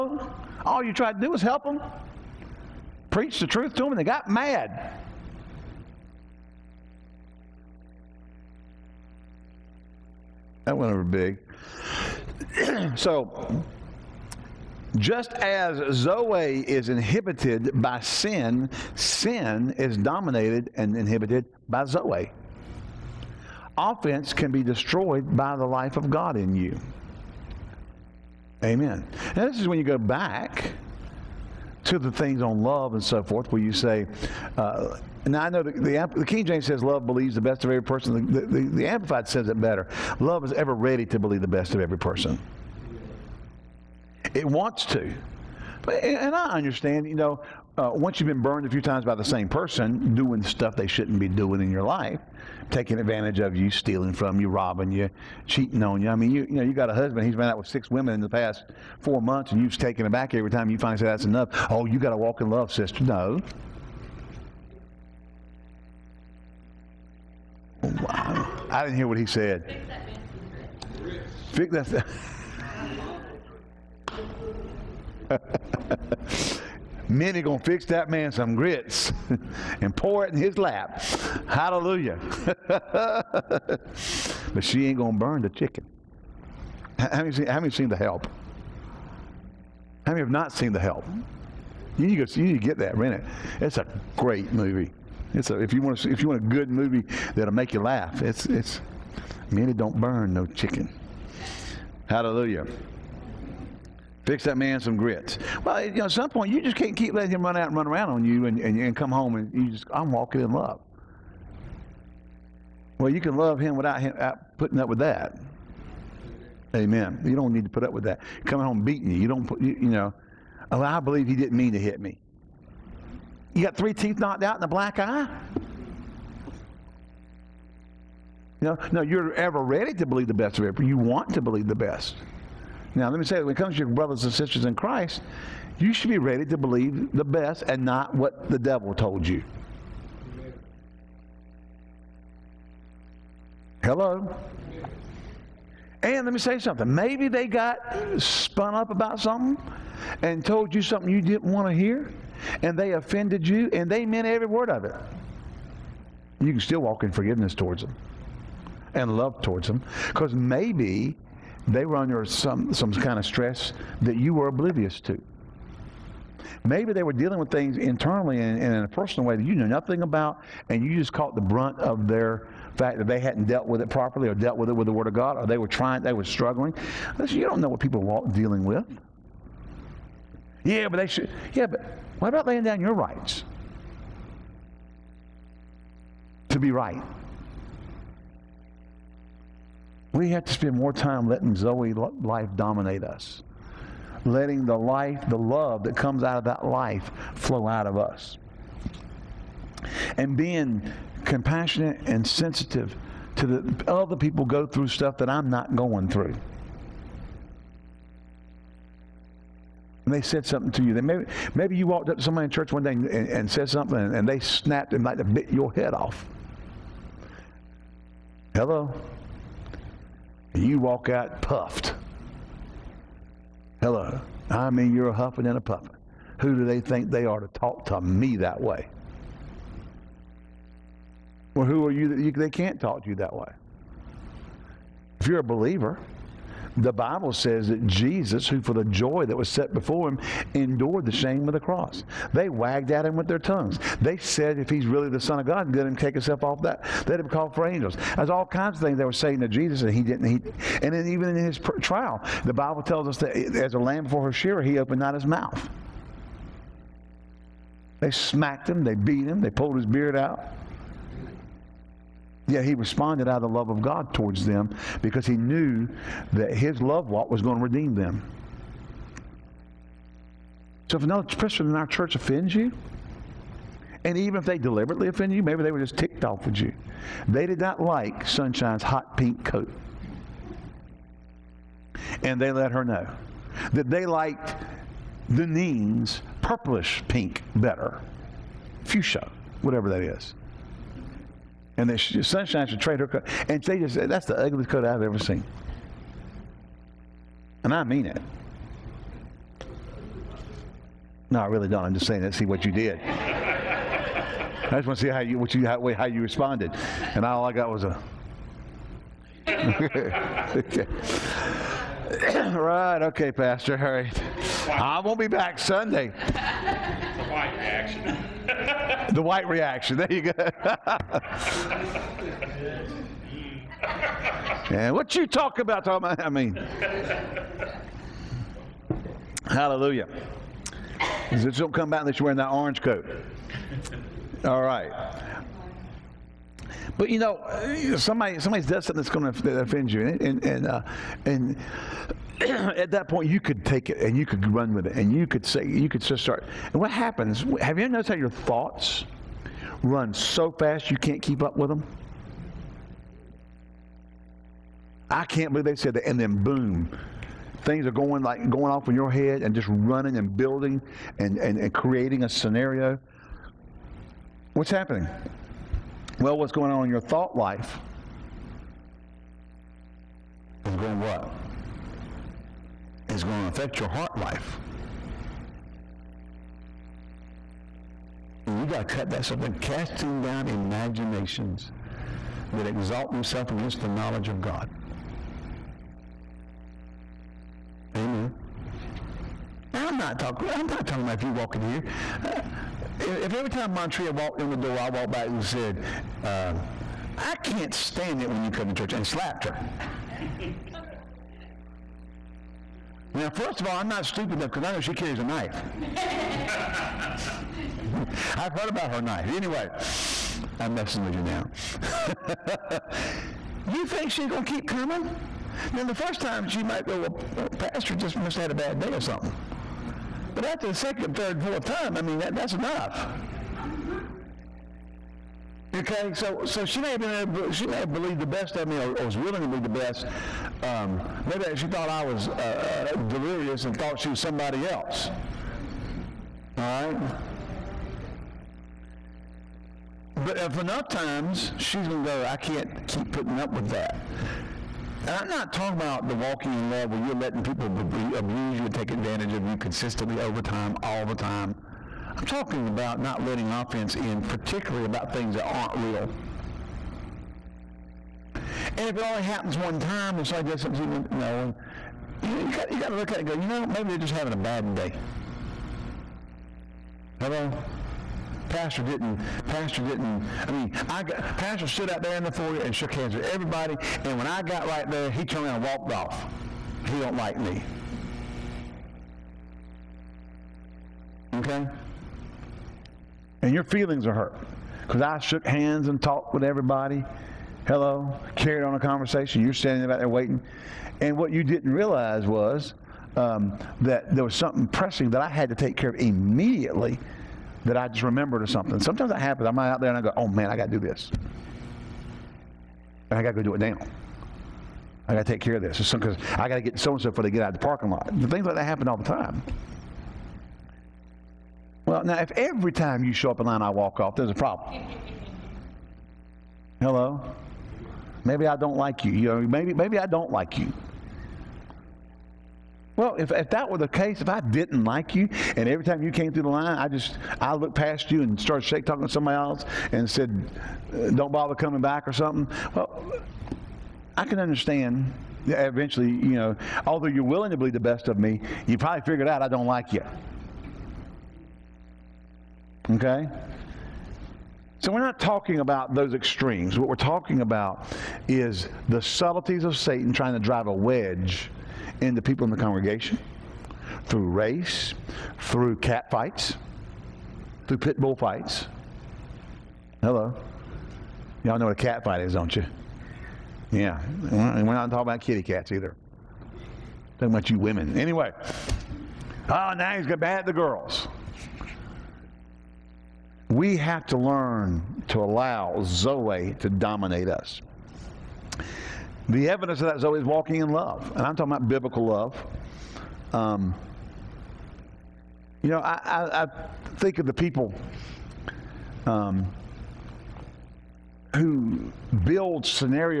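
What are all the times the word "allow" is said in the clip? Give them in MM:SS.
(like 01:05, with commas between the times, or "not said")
09:35.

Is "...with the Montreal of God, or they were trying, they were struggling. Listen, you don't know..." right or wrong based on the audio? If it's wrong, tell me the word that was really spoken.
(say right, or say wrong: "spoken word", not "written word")
wrong: "Word", not "Montreal".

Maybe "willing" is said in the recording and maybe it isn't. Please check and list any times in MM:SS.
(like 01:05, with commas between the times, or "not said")
07:09, 08:57.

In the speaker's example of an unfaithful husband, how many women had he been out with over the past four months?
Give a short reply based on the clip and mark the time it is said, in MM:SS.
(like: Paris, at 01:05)
6, at 00:57.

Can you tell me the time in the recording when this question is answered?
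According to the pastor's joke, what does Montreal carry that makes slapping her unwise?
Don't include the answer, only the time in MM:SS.
06:45.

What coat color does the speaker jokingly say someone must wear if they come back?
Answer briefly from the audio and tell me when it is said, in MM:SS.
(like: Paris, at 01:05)
orange, at 05:32.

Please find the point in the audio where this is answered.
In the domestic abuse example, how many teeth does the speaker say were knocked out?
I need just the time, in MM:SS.
02:03.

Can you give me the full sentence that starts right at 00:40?
Love is ever ready to believe the best of every person.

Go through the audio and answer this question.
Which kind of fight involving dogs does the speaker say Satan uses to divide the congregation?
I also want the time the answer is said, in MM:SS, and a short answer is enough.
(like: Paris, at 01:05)
pit bull fights, at 09:17.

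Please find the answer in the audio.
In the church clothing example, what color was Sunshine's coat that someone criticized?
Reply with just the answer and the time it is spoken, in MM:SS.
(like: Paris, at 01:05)
hot pink, at 04:38.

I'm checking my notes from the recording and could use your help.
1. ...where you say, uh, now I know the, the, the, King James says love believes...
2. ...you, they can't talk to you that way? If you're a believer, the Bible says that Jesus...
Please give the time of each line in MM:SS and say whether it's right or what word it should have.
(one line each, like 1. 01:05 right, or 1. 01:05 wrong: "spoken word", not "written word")
1. 00:33 right
2. 03:52 right.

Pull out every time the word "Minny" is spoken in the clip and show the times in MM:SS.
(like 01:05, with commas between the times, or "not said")
01:17, 01:39.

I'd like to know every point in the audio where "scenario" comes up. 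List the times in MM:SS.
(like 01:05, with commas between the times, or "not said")
06:02, 09:52.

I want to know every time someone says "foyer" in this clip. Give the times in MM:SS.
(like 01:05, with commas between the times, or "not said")
07:52.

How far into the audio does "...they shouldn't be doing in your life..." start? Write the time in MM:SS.
00:50.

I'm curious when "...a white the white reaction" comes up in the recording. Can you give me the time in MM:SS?
05:16.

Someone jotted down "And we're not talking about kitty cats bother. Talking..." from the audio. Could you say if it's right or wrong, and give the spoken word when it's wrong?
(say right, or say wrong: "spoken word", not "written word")
wrong: "either", not "bother".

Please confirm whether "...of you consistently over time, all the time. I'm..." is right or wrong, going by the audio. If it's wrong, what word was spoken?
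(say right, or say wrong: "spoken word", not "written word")
right.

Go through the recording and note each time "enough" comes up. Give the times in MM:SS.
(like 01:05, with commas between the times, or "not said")
01:01, 06:44, 07:02, 07:20.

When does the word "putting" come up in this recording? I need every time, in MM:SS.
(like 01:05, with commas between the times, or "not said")
01:54, 07:23.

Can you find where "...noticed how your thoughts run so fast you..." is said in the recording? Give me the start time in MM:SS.
05:47.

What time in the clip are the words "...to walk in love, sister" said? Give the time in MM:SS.
01:02.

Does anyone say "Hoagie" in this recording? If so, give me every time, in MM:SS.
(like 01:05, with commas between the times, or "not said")
not said.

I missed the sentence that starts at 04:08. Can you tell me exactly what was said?
There's all kinds of things they were saying to Jesus, and he didn't.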